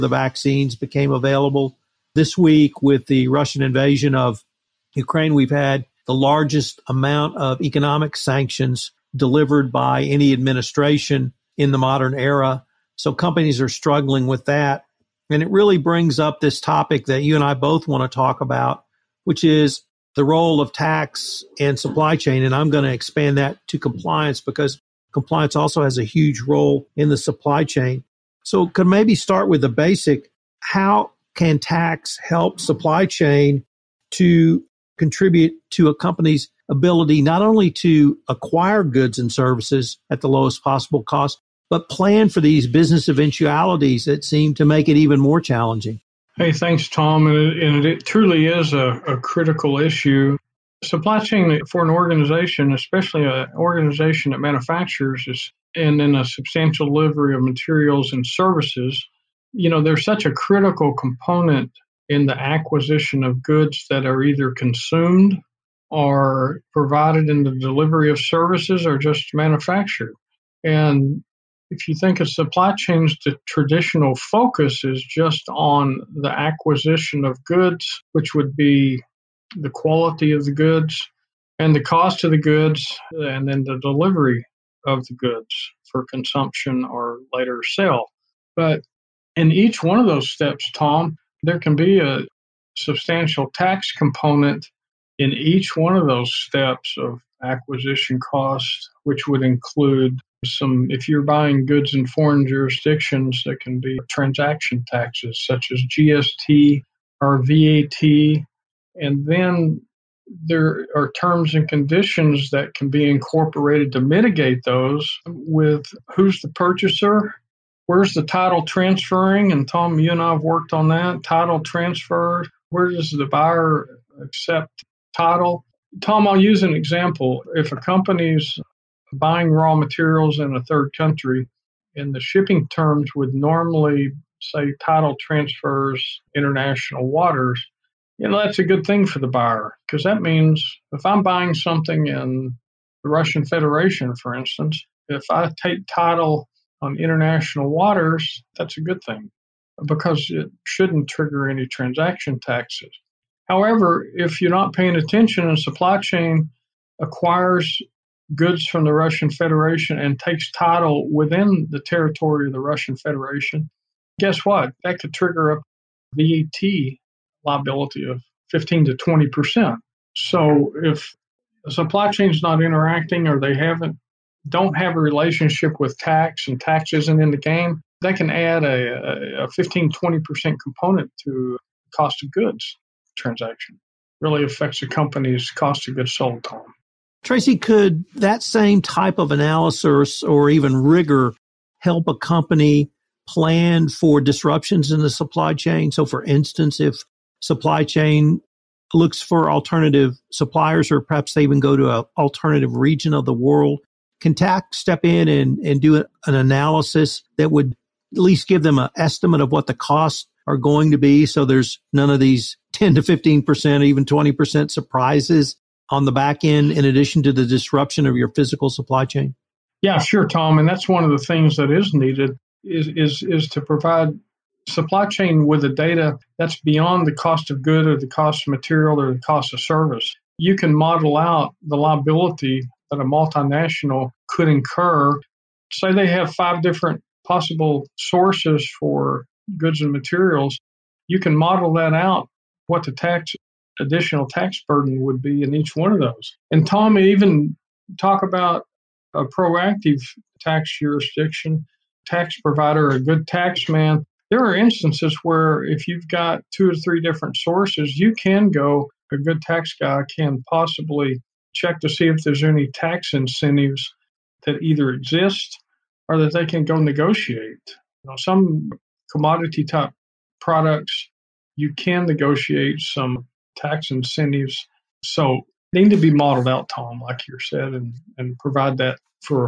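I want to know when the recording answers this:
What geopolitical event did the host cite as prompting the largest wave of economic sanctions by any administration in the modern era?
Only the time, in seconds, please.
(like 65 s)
3 s.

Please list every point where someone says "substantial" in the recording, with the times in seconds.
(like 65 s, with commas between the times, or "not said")
56 s, 92 s.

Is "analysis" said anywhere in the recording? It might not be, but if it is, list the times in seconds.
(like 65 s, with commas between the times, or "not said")
189 s, 206 s.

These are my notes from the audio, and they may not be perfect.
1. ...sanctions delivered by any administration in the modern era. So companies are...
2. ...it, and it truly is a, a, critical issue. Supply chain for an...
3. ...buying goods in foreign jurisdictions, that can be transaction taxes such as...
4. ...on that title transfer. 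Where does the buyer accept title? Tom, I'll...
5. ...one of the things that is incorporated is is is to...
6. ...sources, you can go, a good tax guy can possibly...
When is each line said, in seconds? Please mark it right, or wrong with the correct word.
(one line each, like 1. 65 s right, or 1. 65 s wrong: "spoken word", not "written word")
1. 8 s right
2. 47 s right
3. 101 s right
4. 120 s right
5. 220 s wrong: "needed", not "incorporated"
6. 257 s right.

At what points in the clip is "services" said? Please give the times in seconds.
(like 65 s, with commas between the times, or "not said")
39 s, 58 s, 68 s, 229 s.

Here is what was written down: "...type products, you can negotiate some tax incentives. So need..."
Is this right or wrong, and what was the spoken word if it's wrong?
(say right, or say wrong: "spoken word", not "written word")
right.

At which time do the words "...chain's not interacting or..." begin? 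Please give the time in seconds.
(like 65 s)
172 s.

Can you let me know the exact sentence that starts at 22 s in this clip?
And I'm going to expand that to compliance because compliance also has a huge role in the supply chain.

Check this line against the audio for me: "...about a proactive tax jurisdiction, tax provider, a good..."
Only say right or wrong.
right.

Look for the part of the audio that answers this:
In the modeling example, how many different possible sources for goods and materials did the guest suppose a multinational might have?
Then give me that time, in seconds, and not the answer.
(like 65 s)
236 s.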